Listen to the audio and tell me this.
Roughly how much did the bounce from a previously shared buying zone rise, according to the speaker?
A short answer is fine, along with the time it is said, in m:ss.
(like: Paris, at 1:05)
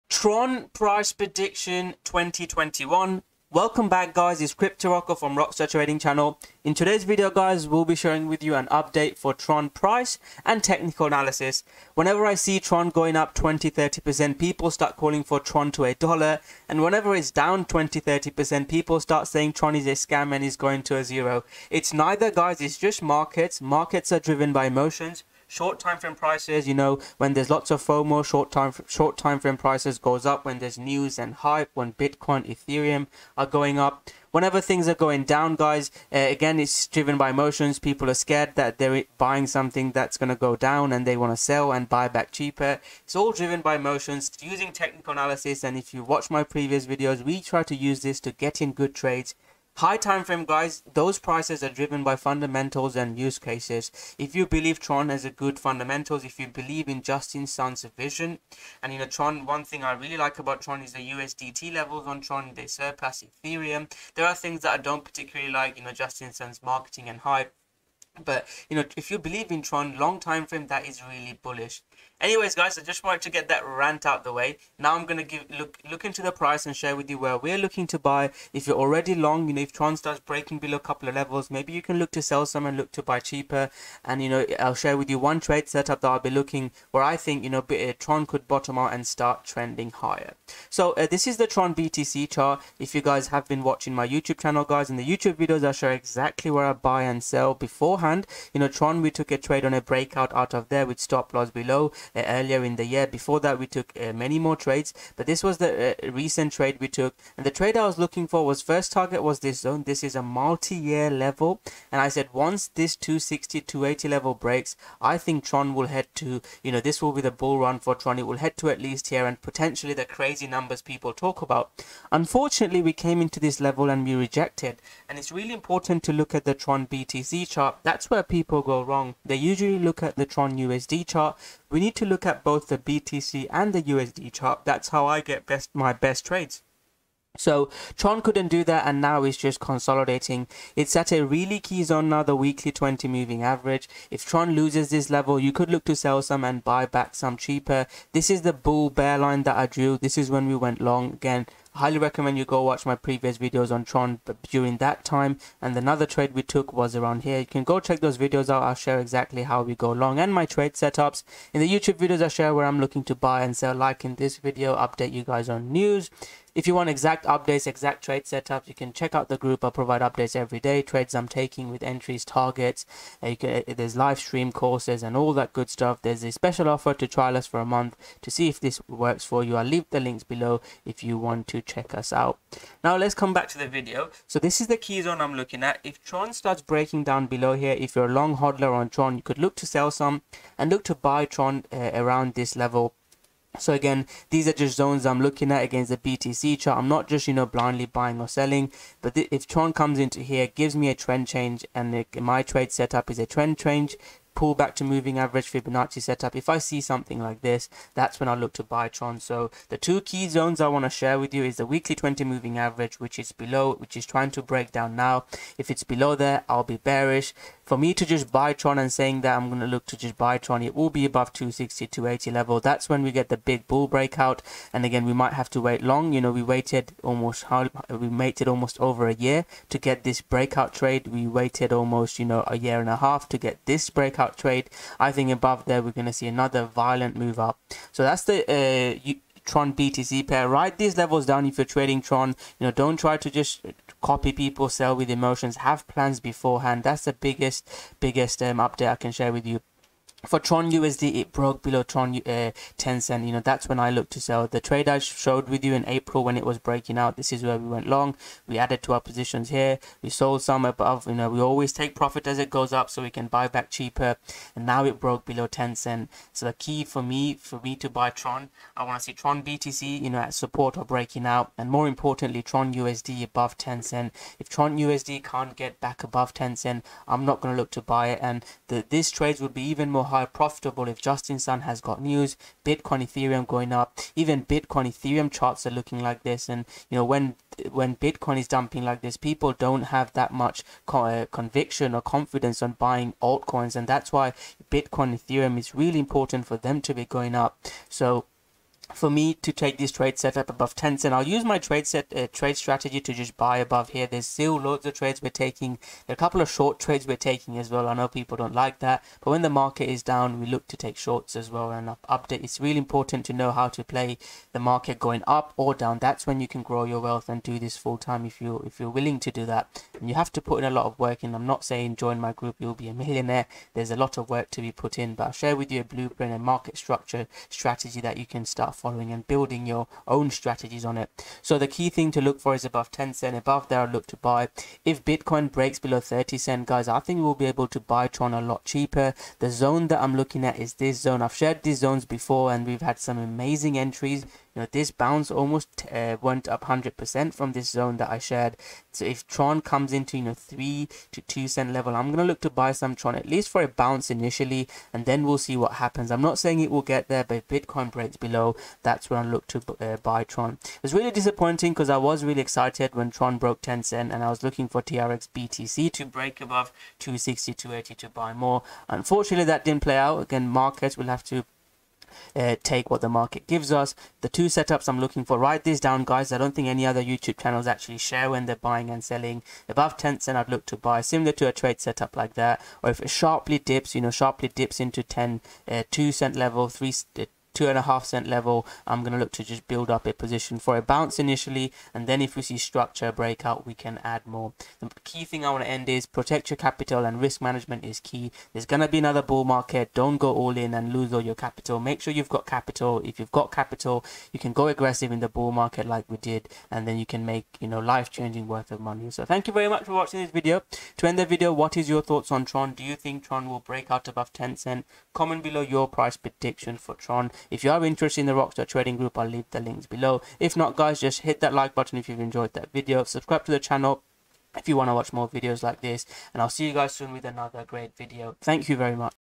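100%, at 5:46.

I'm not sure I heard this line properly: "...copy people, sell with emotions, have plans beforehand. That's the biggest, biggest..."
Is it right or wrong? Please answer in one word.
right.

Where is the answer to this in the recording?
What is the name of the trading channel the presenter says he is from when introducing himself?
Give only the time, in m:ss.
0:05.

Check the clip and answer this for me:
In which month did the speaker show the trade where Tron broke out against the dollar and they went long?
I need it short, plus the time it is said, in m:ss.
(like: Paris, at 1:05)
April, at 4:15.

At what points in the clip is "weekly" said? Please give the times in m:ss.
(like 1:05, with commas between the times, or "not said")
2:22, 3:31.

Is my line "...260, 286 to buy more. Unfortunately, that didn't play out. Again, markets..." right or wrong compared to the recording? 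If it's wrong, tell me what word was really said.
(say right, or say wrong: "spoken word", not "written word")
wrong: "280", not "286".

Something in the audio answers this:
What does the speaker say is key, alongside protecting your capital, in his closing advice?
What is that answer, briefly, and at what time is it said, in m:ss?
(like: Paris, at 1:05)
risk management, at 6:37.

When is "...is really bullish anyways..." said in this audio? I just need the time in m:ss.
1:10.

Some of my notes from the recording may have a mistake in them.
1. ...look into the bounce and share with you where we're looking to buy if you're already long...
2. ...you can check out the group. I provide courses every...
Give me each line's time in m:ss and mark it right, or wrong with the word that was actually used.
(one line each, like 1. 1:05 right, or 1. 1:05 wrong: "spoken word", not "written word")
1. 1:15 wrong: "price", not "bounce"
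2. 2:48 wrong: "updates", not "courses".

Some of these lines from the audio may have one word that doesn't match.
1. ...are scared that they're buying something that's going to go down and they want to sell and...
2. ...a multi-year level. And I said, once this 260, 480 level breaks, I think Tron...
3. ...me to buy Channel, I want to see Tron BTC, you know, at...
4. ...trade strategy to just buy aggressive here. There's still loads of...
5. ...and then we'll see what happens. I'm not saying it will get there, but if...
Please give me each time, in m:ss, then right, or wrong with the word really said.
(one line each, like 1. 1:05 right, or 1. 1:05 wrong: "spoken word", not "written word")
1. 0:38 right
2. 1:50 wrong: "280", not "480"
3. 4:27 wrong: "Tron", not "Channel"
4. 5:02 wrong: "above", not "aggressive"
5. 5:54 right.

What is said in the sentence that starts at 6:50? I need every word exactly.
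To end the video, what is your thoughts on Tron?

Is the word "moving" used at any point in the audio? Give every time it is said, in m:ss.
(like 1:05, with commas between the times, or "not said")
2:23, 3:24, 3:32.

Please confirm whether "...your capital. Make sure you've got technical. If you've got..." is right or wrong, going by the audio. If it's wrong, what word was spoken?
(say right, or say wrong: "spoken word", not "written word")
wrong: "capital", not "technical".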